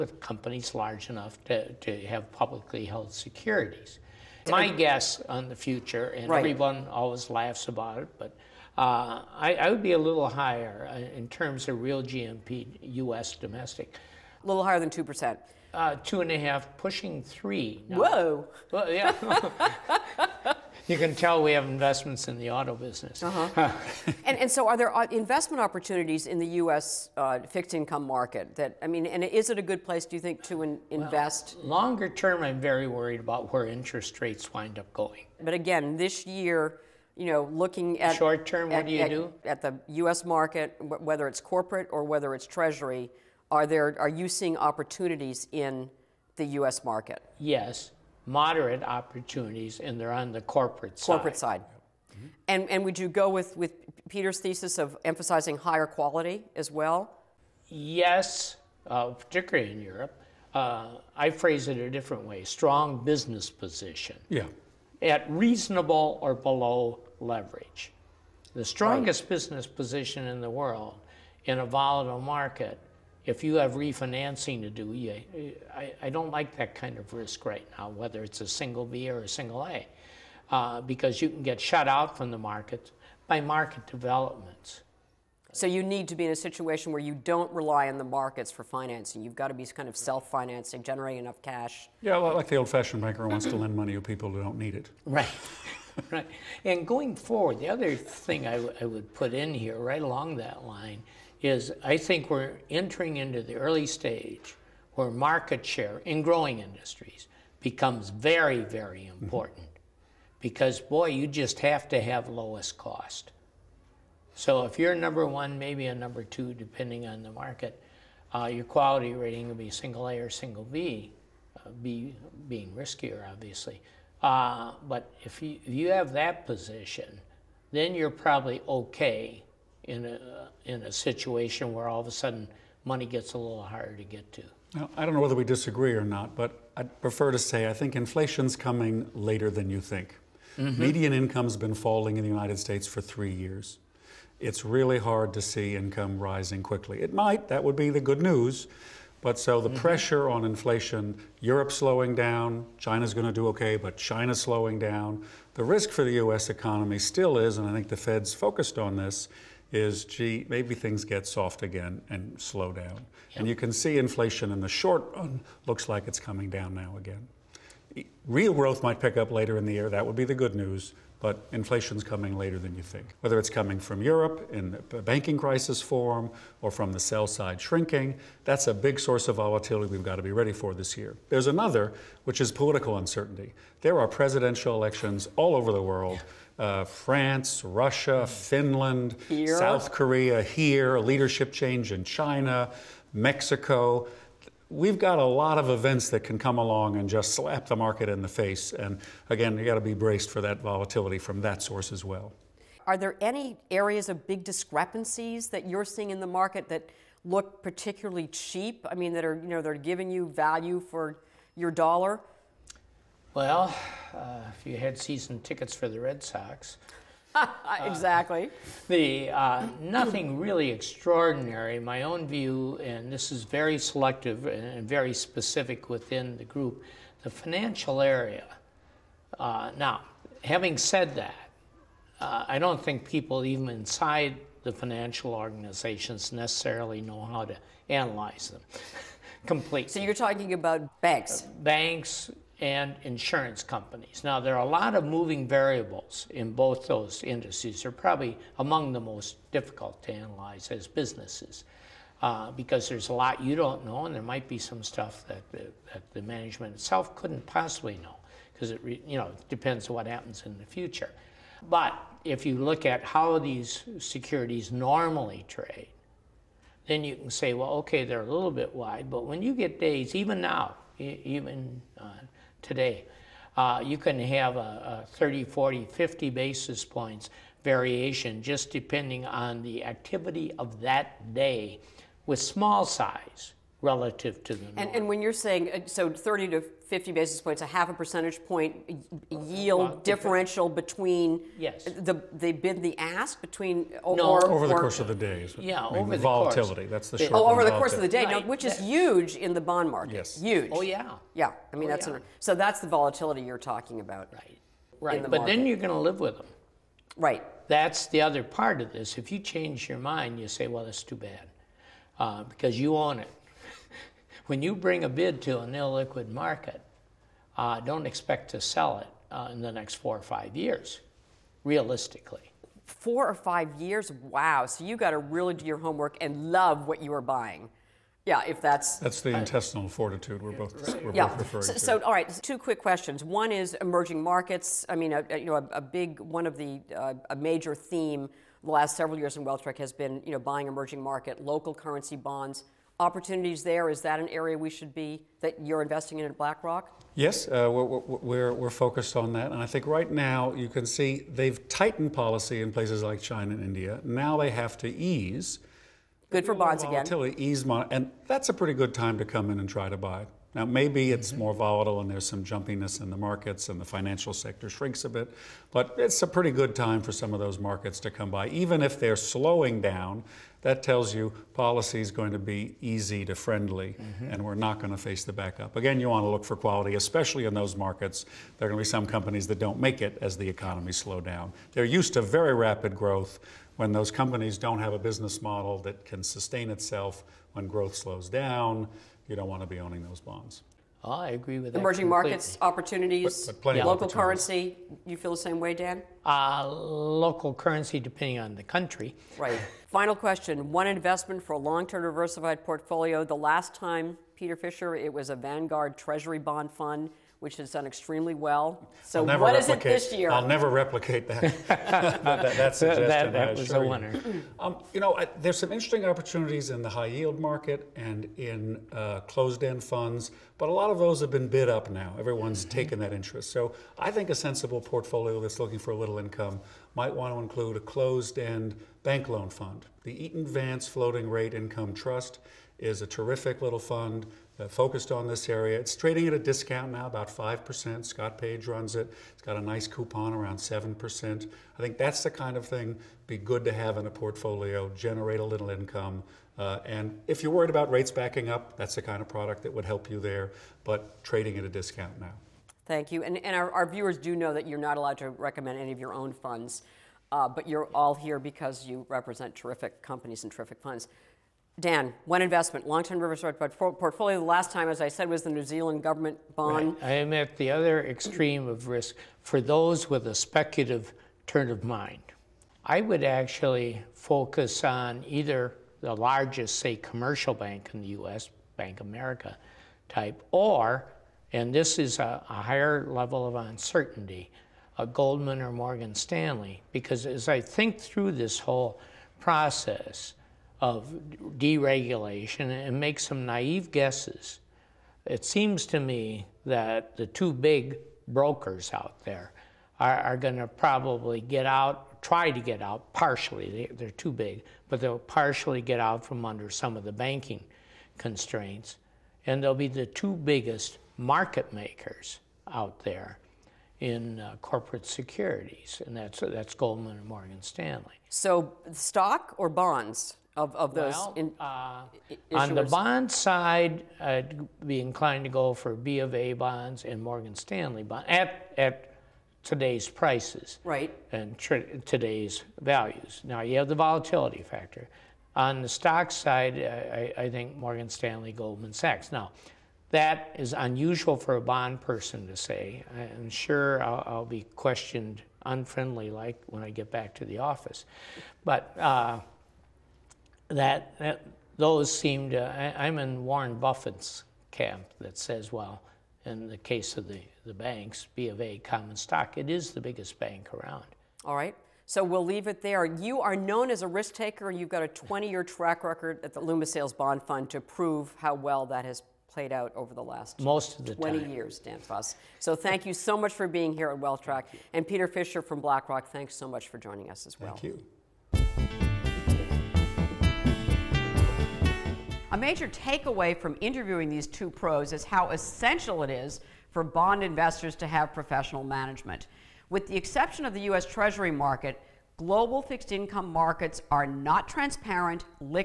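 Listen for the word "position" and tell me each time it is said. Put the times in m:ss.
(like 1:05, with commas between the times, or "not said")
1:03, 1:09, 2:06.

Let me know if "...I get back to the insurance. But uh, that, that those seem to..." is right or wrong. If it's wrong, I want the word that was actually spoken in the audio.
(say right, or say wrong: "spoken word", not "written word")
wrong: "office", not "insurance".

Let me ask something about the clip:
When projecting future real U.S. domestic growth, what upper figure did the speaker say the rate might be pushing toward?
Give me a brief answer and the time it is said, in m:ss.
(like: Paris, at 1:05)
3, at 0:16.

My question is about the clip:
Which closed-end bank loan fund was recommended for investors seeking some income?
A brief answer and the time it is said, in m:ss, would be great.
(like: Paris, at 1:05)
Eaton Vance Floating Rate Income Trust, at 7:10.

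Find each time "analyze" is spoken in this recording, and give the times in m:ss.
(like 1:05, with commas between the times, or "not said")
3:57, 4:10.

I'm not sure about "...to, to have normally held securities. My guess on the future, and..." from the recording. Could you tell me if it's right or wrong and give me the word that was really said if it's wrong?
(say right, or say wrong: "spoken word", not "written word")
wrong: "publicly", not "normally".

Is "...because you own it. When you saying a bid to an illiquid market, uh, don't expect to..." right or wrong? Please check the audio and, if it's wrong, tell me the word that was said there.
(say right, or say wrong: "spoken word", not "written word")
wrong: "bring", not "saying".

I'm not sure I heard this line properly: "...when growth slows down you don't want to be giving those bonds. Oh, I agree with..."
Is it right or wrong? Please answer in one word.
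wrong.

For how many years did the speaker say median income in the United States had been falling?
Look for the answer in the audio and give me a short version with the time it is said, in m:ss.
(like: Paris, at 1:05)
3, at 2:22.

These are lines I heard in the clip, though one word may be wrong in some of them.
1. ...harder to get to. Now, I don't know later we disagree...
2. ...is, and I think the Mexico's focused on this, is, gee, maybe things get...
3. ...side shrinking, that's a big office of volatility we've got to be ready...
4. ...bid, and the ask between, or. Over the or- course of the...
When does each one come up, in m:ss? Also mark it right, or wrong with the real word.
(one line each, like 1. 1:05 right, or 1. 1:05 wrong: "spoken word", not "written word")
1. 2:13 wrong: "whether", not "later"
2. 2:37 wrong: "Fed", not "Mexico"
3. 2:57 wrong: "source", not "office"
4. 4:52 right.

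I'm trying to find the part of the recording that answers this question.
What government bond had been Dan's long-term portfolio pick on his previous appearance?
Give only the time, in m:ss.
7:45.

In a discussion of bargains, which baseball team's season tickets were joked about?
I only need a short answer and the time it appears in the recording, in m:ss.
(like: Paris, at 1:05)
Red Sox, at 3:35.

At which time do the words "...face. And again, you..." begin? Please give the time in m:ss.
3:18.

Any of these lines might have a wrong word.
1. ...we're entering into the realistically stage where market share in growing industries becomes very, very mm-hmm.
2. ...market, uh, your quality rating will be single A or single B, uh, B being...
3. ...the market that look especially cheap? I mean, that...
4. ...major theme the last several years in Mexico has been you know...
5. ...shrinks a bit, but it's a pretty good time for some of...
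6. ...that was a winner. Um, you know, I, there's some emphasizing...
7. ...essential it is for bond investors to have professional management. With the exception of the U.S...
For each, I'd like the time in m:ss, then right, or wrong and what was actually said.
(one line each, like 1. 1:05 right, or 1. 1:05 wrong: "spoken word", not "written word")
1. 1:42 wrong: "early", not "realistically"
2. 1:57 right
3. 3:26 wrong: "particularly", not "especially"
4. 5:37 wrong: "Wealthtrack", not "Mexico"
5. 6:04 right
6. 6:53 wrong: "interesting", not "emphasizing"
7. 9:45 right.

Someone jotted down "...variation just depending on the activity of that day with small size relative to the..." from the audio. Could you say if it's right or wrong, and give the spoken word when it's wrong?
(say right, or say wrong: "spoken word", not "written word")
right.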